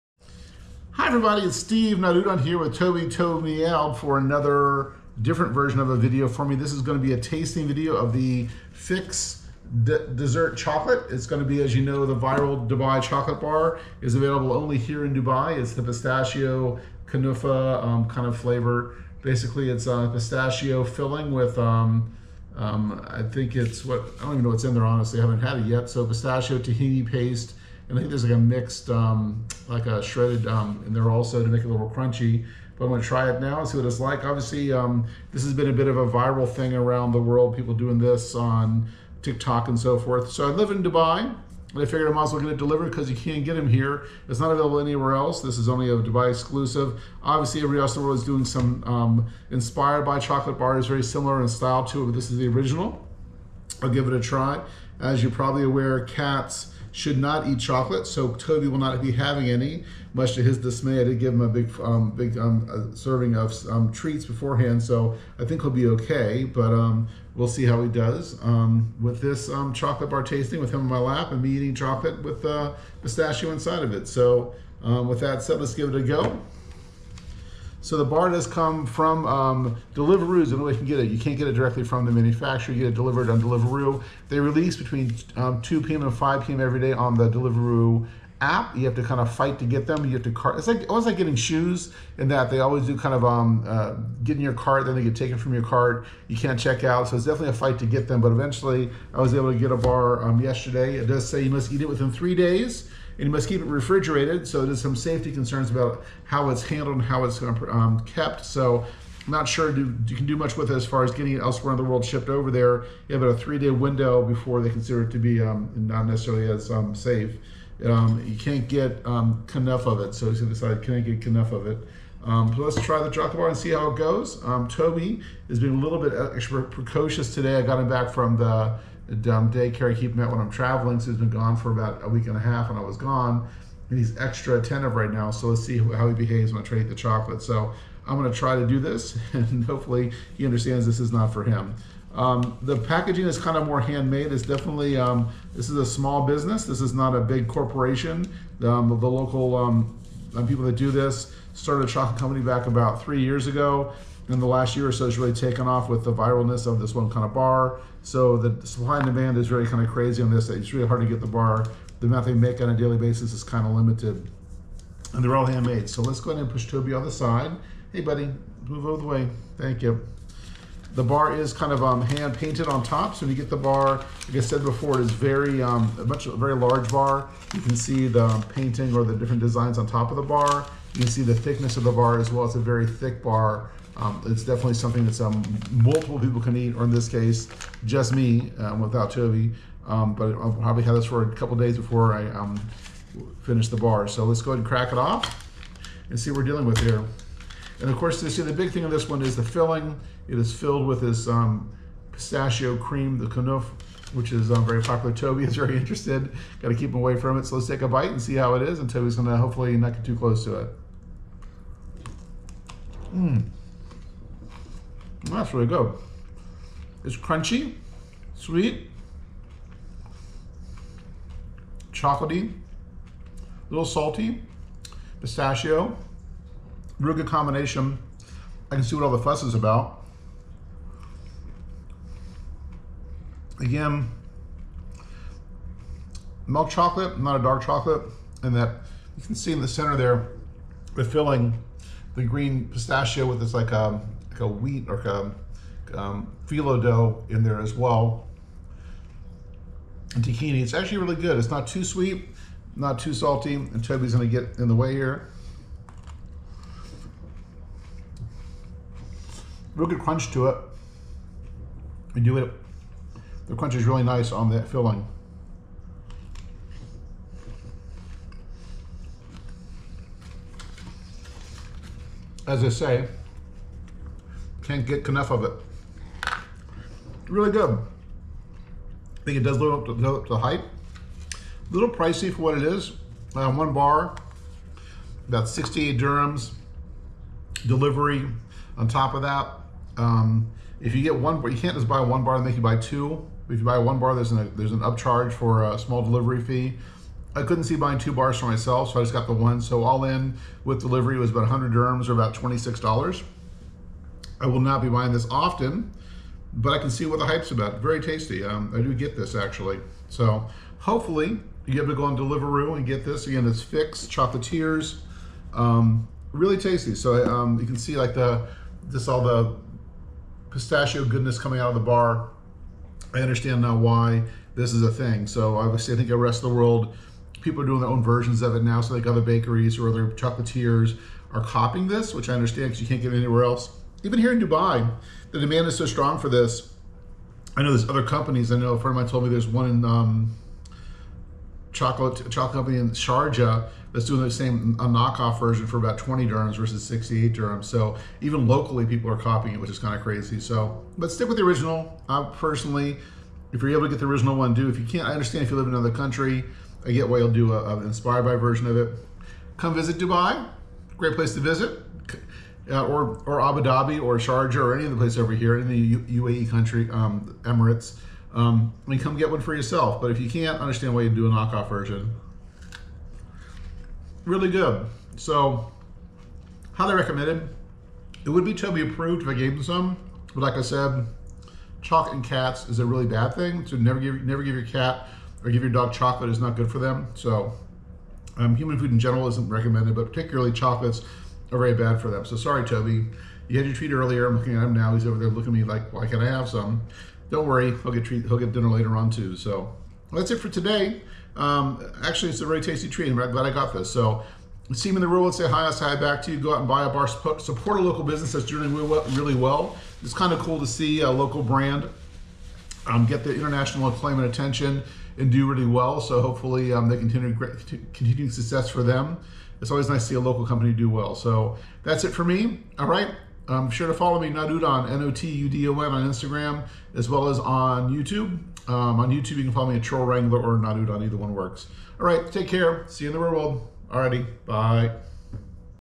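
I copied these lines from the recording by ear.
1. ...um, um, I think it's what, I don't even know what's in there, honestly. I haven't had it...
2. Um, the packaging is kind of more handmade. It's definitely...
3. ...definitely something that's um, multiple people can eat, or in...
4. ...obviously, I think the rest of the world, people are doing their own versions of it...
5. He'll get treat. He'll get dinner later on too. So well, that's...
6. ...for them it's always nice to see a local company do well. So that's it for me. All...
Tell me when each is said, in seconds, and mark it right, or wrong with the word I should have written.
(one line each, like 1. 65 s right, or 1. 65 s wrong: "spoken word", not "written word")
1. 21 s right
2. 142 s right
3. 184 s right
4. 325 s right
5. 397 s right
6. 418 s right.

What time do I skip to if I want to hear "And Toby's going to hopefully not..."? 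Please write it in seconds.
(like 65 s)
208 s.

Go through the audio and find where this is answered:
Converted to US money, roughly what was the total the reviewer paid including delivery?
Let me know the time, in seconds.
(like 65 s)
302 s.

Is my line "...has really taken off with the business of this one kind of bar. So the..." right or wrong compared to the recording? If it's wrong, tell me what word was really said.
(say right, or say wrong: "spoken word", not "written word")
wrong: "viralness", not "business".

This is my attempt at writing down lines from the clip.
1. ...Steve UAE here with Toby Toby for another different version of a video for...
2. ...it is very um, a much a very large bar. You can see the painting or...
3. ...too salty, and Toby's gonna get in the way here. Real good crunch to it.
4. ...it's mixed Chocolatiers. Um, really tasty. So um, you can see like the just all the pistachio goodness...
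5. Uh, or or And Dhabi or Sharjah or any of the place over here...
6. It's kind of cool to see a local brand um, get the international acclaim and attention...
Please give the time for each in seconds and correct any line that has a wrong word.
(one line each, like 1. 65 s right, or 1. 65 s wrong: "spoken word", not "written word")
1. 1 s wrong: "NotUdon", not "UAE"
2. 174 s right
3. 252 s right
4. 313 s wrong: "fixed", not "mixed"
5. 362 s wrong: "Abu", not "And"
6. 410 s right.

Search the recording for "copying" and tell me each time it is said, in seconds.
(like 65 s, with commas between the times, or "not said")
331 s, 349 s.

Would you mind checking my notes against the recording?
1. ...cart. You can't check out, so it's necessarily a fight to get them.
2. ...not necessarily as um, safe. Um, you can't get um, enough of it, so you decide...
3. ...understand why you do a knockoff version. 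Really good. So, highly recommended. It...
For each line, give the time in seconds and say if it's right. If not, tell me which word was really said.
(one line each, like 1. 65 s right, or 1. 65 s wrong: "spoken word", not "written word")
1. 95 s wrong: "definitely", not "necessarily"
2. 115 s right
3. 370 s right.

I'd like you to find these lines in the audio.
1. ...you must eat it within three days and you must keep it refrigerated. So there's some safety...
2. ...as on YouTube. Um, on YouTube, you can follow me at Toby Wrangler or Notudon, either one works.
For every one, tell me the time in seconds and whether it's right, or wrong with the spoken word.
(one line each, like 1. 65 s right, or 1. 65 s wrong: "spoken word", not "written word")
1. 101 s right
2. 427 s wrong: "Troll", not "Toby".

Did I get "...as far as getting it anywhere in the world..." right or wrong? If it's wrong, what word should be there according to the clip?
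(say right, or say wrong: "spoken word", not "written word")
wrong: "elsewhere", not "anywhere".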